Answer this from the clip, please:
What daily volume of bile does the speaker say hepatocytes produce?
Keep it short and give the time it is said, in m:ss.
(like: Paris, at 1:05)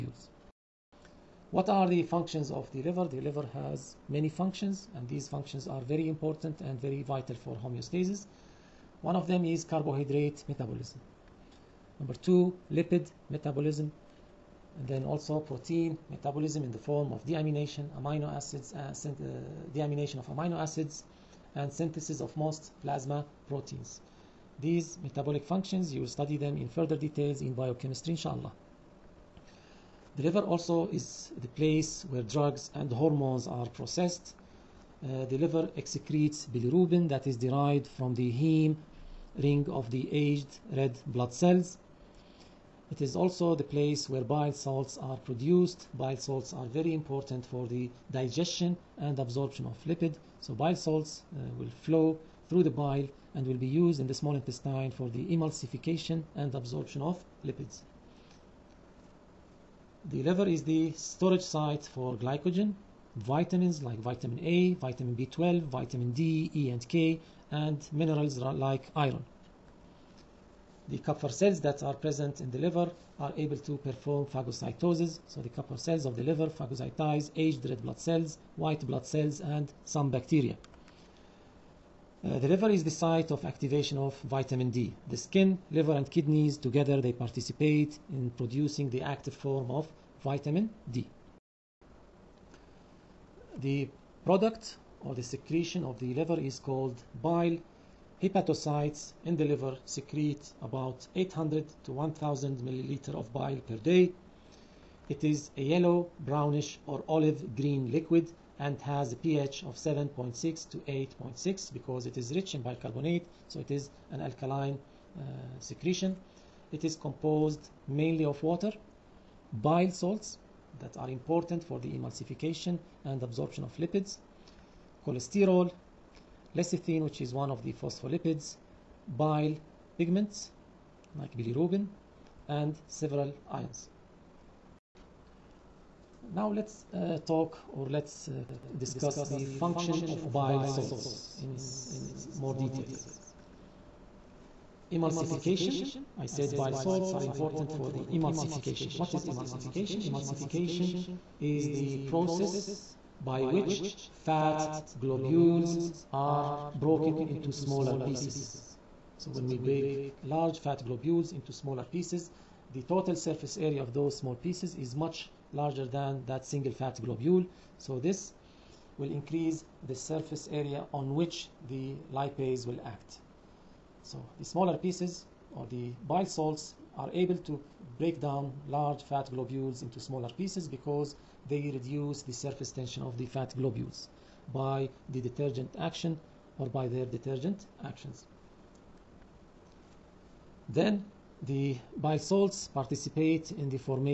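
800 to 1000 milliliters, at 1:41.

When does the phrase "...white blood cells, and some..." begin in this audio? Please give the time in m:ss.
1:18.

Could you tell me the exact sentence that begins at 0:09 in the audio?
One of them is carbohydrate metabolism.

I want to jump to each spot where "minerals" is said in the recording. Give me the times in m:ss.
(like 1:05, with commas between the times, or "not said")
1:07.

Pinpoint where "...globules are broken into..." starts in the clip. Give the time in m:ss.
2:35.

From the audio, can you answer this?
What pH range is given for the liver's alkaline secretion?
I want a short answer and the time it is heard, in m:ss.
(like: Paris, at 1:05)
7.6 to 8.6, at 1:49.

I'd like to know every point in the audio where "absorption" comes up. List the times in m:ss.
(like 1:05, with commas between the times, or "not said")
0:49, 0:56, 2:03.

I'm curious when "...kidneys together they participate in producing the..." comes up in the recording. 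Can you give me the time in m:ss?
1:26.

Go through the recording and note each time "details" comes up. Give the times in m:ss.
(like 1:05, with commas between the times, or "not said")
0:26, 2:22.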